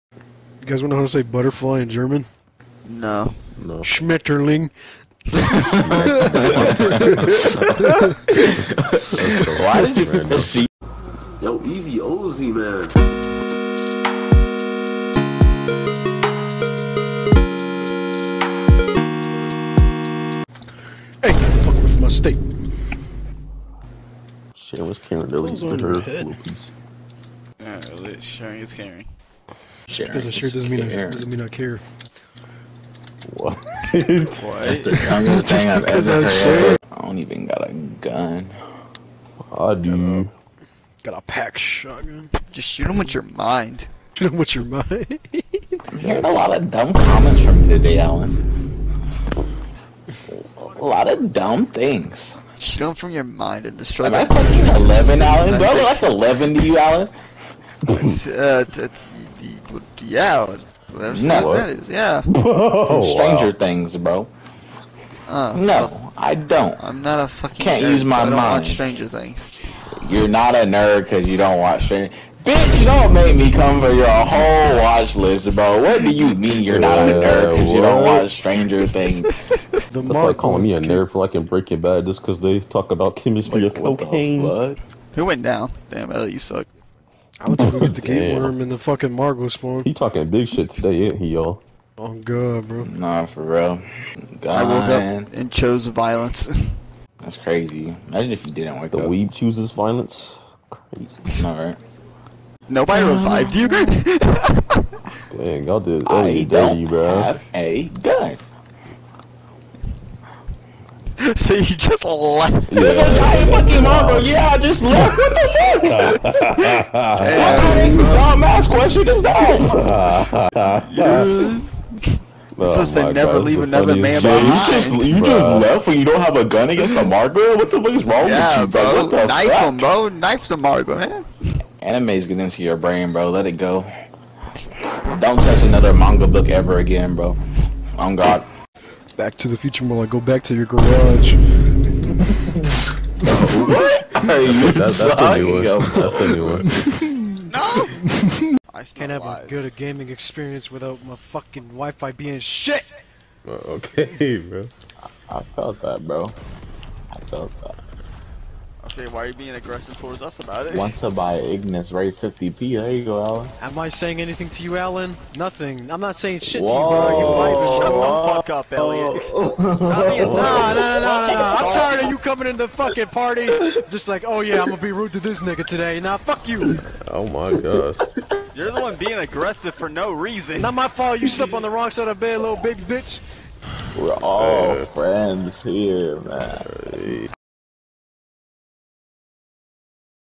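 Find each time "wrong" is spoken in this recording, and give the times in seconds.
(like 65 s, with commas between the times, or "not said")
128 s, 181 s.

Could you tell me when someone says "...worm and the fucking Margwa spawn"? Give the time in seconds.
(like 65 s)
88 s.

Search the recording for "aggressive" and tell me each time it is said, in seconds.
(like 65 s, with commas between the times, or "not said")
159 s, 179 s.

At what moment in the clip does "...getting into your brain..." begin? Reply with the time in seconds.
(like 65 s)
132 s.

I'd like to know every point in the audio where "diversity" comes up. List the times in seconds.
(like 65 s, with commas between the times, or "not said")
not said.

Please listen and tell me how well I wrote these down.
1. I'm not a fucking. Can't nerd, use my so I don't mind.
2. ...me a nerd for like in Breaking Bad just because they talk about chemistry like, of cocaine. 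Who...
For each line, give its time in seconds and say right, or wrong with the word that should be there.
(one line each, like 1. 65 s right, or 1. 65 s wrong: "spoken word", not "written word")
1. 66 s right
2. 80 s right.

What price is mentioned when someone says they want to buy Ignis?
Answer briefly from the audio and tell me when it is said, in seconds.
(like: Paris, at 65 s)
50p, at 162 s.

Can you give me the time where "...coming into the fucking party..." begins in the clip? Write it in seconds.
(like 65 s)
172 s.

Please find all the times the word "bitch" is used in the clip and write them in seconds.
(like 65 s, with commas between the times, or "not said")
72 s, 182 s.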